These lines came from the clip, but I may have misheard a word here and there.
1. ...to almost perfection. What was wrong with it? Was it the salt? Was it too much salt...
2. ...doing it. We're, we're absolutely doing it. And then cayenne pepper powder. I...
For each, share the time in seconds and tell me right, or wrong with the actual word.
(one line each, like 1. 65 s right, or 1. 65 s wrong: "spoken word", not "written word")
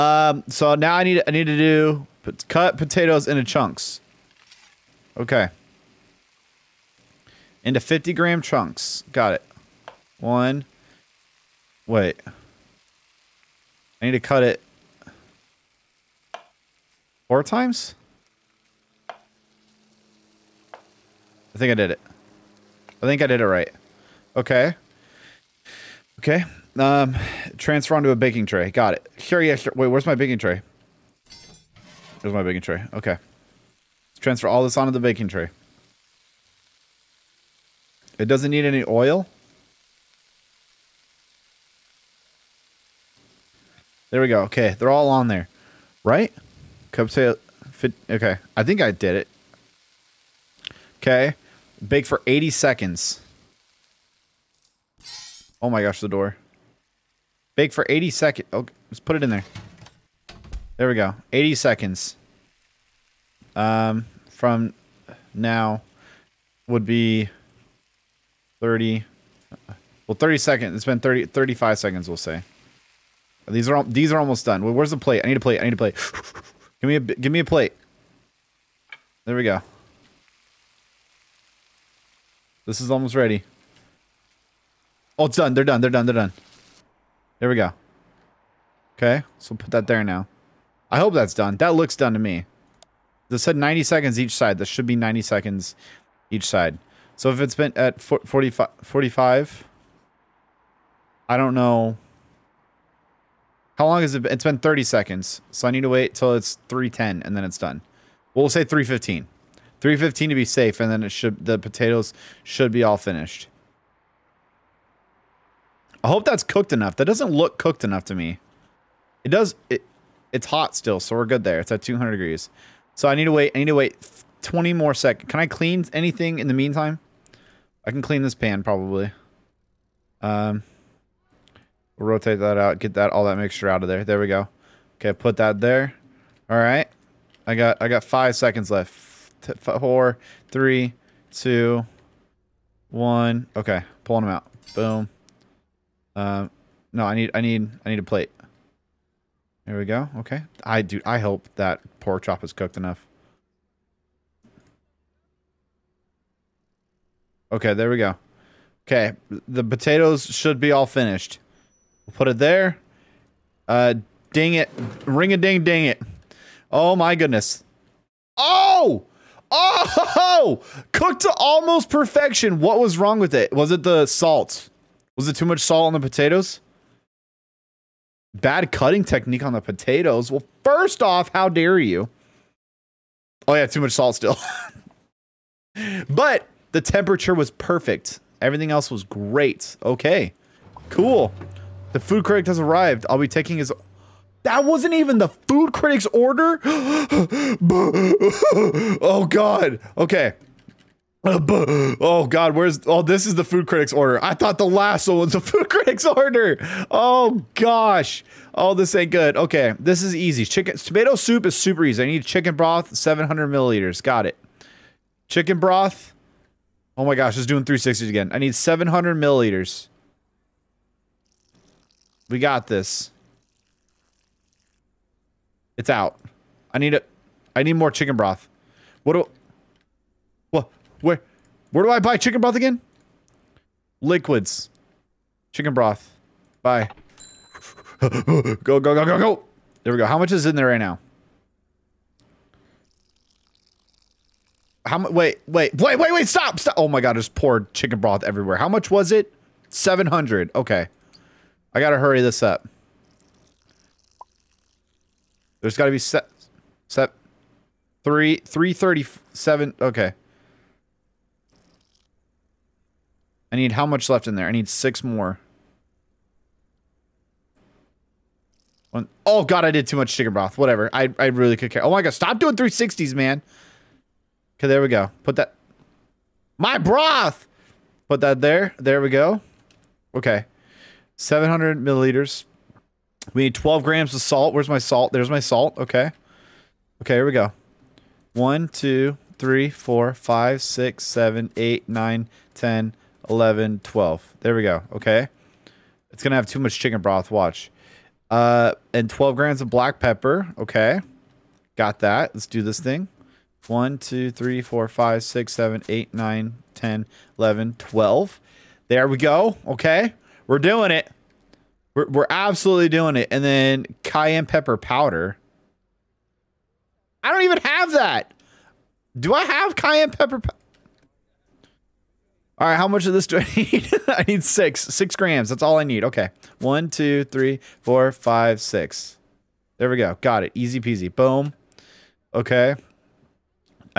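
1. 171 s right
2. 310 s right.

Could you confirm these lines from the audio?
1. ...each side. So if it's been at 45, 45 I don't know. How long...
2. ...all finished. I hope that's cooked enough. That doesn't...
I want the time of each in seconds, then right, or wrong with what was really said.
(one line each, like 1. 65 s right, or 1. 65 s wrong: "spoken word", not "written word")
1. 96 s right
2. 112 s right.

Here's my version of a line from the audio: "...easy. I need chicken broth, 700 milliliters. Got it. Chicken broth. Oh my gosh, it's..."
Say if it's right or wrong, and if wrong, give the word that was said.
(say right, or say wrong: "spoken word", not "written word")
right.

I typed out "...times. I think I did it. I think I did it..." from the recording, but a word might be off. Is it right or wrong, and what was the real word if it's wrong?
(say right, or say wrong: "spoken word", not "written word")
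right.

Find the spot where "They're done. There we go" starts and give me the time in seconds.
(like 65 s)
86 s.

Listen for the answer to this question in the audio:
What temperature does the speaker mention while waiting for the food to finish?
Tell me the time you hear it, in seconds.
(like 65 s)
121 s.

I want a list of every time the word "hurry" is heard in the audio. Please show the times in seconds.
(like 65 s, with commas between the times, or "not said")
251 s.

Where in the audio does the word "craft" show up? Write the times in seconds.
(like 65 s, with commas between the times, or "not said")
not said.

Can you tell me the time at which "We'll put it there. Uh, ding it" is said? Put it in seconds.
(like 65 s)
162 s.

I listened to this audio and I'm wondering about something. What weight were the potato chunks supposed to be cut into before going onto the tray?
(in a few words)
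50 grams.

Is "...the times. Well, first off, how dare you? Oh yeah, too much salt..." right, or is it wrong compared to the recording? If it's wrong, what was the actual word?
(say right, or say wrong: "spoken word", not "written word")
wrong: "potatoes", not "times".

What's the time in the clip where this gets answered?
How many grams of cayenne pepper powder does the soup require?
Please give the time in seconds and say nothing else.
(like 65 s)
324 s.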